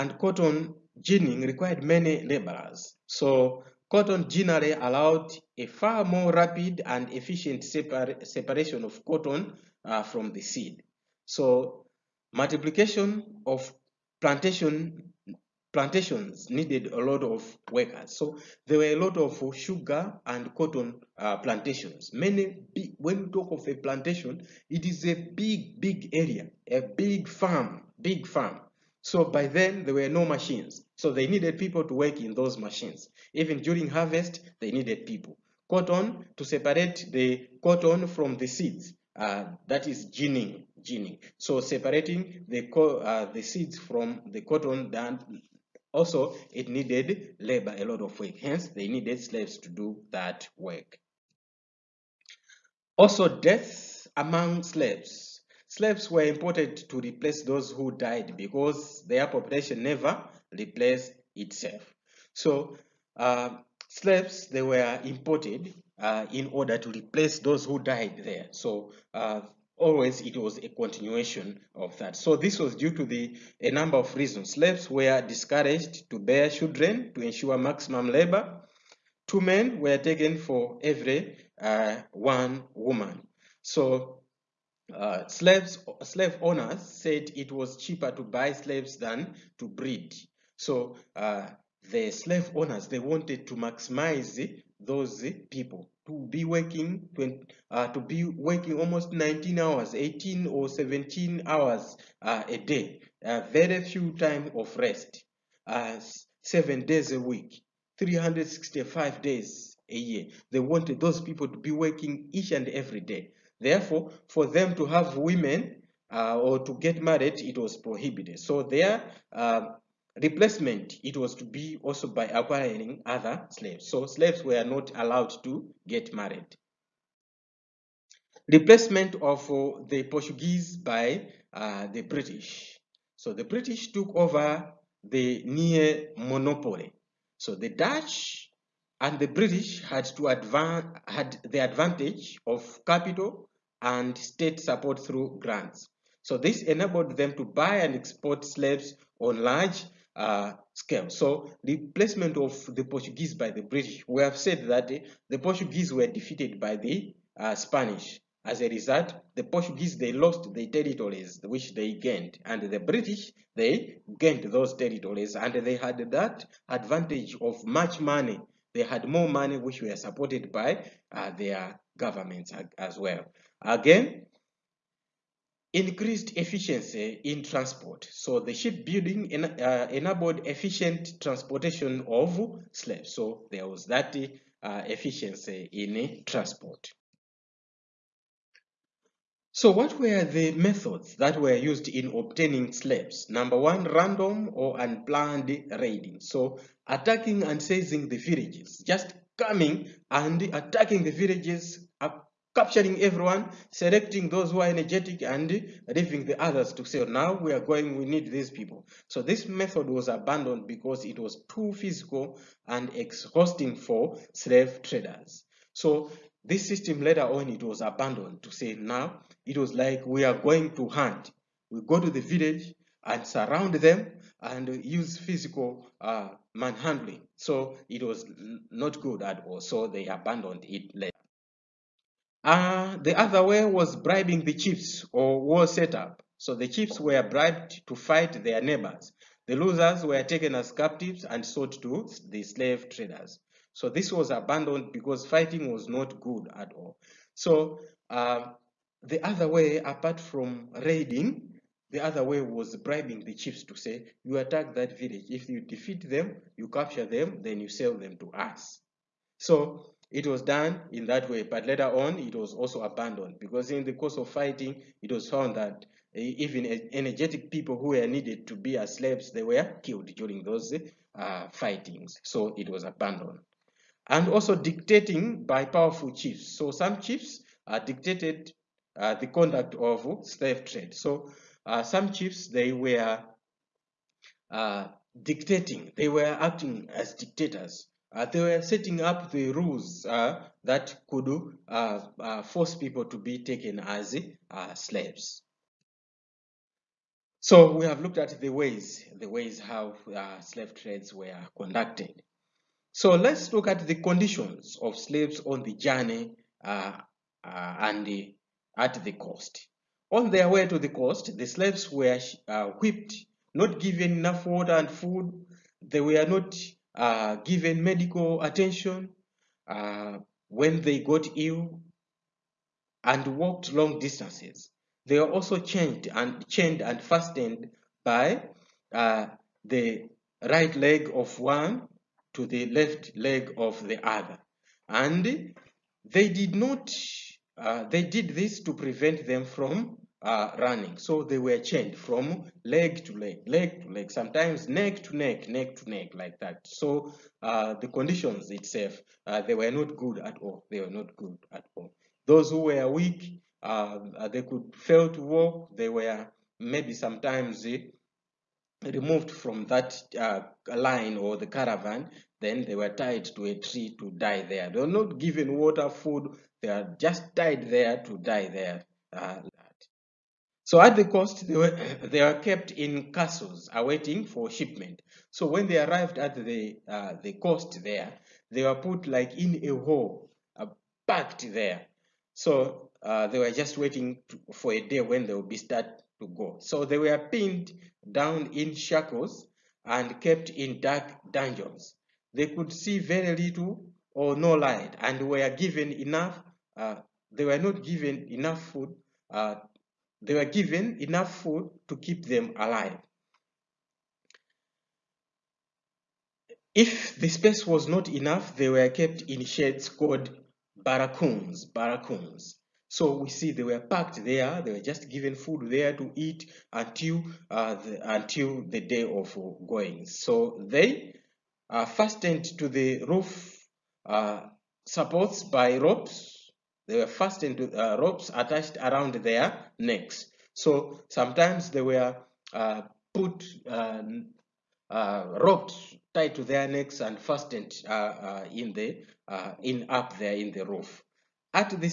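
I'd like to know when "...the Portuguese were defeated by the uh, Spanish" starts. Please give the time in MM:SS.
02:35.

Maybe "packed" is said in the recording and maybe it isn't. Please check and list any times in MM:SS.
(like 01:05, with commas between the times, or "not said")
06:21, 06:53.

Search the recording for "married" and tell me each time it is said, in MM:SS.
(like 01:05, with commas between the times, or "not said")
01:57, 02:06.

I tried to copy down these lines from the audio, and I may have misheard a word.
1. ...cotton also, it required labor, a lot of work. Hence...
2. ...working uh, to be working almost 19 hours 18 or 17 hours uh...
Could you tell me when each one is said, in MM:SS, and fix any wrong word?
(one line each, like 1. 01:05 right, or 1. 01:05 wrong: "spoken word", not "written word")
1. 00:44 wrong: "needed", not "required"
2. 01:36 right.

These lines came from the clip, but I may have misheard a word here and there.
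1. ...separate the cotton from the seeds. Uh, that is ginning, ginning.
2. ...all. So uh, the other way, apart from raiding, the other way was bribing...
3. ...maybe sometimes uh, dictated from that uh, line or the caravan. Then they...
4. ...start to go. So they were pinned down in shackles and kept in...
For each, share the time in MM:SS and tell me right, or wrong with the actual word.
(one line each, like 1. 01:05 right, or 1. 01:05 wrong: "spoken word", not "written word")
1. 00:36 right
2. 04:06 right
3. 05:56 wrong: "removed", not "dictated"
4. 06:25 right.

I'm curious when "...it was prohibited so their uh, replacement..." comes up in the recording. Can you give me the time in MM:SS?
01:57.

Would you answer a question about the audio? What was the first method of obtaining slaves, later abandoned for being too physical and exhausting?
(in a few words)
Random or unplanned raiding.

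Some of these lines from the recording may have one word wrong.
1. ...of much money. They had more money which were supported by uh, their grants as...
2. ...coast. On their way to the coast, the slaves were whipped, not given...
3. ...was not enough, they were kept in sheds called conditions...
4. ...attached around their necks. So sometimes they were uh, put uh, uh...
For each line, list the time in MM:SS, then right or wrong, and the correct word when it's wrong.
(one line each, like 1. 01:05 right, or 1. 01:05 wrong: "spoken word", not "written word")
1. 02:47 wrong: "governments", not "grants"
2. 05:09 right
3. 06:47 wrong: "barracoons", not "conditions"
4. 07:08 right.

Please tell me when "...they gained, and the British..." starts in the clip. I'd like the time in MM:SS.
02:41.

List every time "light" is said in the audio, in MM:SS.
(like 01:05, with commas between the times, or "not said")
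06:34.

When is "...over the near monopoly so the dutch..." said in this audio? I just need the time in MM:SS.
02:14.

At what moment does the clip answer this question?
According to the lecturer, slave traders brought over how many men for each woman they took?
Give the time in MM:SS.
01:19.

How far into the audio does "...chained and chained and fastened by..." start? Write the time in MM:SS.
05:25.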